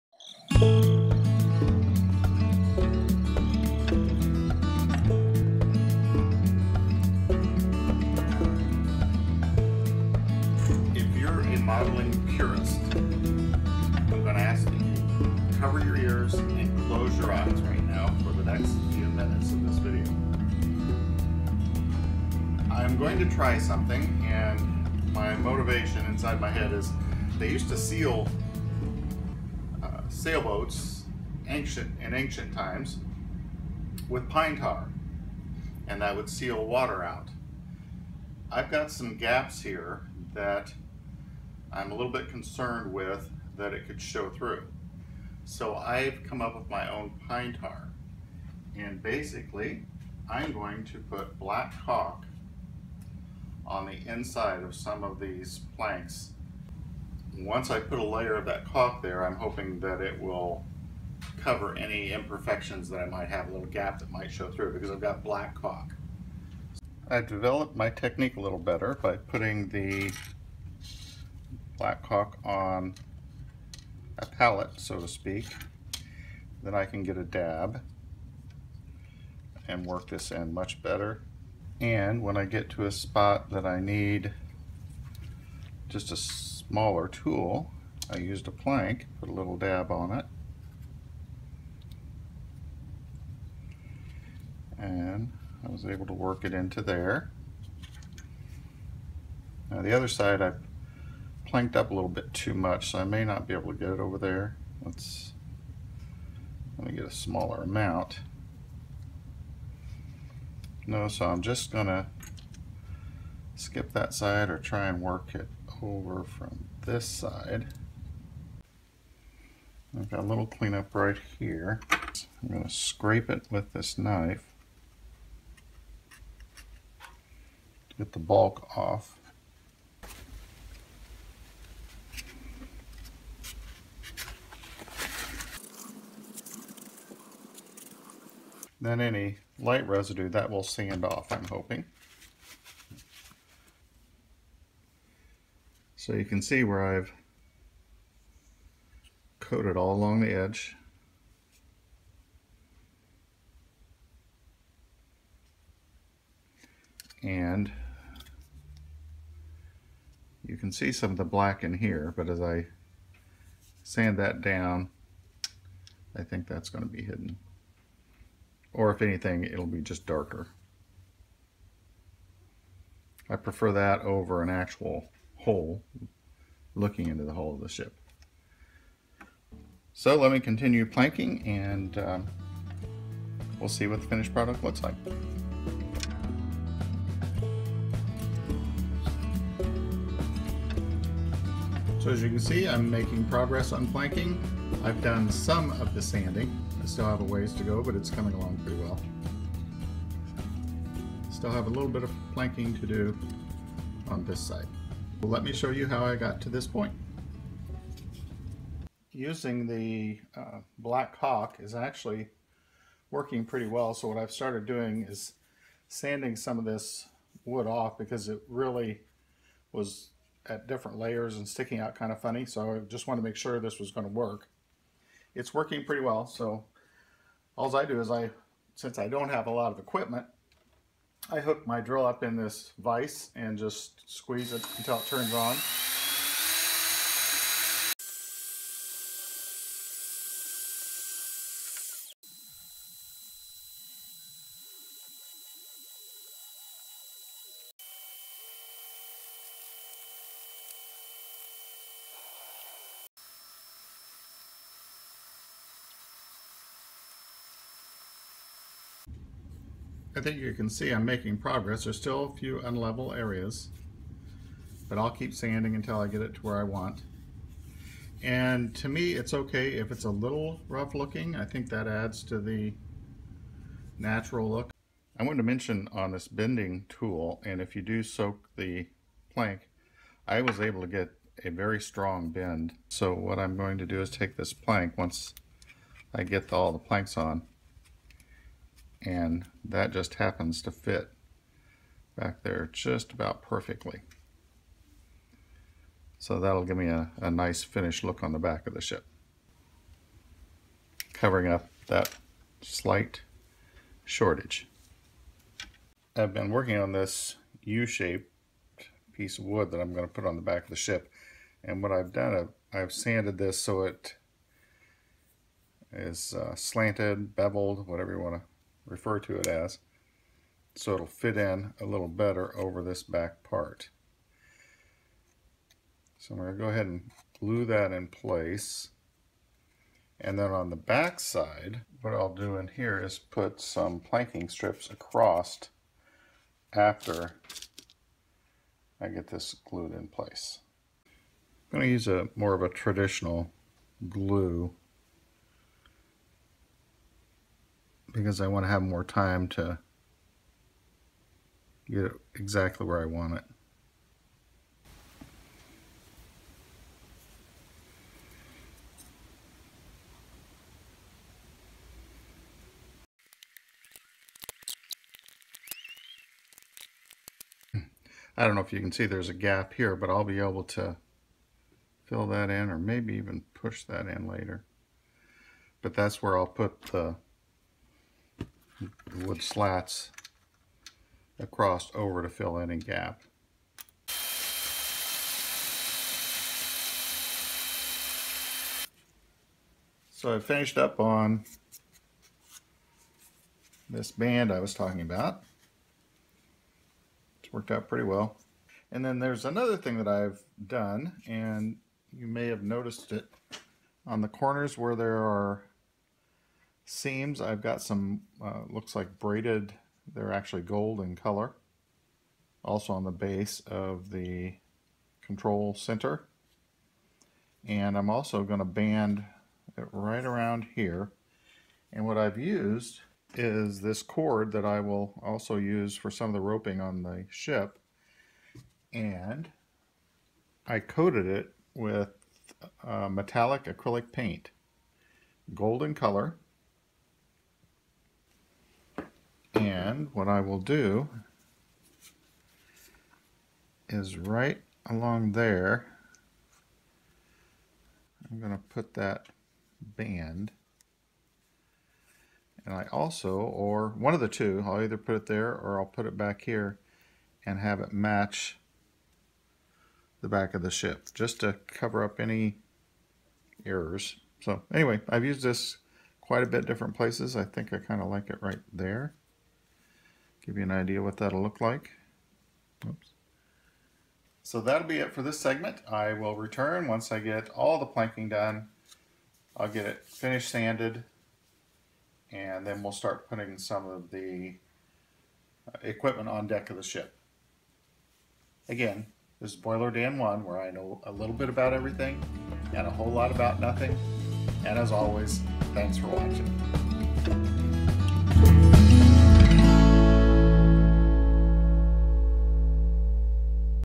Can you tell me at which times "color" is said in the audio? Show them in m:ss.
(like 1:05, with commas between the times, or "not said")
6:51, 7:15.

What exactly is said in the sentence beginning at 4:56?
So that'll give me a, a nice finished look on the back of the ship.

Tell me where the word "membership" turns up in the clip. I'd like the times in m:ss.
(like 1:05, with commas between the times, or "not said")
not said.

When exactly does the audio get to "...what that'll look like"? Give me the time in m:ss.
7:51.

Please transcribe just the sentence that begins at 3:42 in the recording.
So I just wanted to make sure this was going to work it's working pretty well.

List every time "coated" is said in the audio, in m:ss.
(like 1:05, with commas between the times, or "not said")
2:29, 7:10.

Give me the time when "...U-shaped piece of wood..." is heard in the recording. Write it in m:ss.
5:07.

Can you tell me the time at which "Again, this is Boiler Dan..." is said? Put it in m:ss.
8:08.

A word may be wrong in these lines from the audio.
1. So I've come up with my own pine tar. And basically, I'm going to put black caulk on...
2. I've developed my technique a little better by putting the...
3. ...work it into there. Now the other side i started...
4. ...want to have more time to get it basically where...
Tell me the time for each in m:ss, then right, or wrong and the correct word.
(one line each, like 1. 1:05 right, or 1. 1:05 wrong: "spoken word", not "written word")
1. 0:45 right
2. 1:07 right
3. 1:36 wrong: "planked", not "started"
4. 5:48 wrong: "exactly", not "basically".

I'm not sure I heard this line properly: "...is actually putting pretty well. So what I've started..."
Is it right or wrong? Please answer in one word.
wrong.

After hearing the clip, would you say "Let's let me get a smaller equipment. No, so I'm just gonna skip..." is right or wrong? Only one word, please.
wrong.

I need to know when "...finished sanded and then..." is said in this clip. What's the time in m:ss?
8:00.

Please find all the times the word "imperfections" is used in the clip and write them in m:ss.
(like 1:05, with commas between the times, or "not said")
1:02.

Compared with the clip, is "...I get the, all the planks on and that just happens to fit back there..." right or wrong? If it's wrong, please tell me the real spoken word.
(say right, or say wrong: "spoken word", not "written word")
right.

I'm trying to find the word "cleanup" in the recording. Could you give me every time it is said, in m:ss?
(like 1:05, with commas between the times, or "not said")
2:00.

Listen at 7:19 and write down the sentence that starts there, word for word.
And what I will do is right along there, I'm going to put that band.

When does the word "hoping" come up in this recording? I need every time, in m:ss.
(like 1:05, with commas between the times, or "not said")
0:59, 2:21.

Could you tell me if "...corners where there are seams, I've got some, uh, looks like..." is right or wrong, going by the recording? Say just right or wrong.
right.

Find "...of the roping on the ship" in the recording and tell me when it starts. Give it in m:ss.
7:06.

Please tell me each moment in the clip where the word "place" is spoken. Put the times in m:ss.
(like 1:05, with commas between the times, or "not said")
5:28, 5:40, 7:46.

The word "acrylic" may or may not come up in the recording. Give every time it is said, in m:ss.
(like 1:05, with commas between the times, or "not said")
7:13.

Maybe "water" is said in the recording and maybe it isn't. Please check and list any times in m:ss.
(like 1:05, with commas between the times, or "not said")
0:36.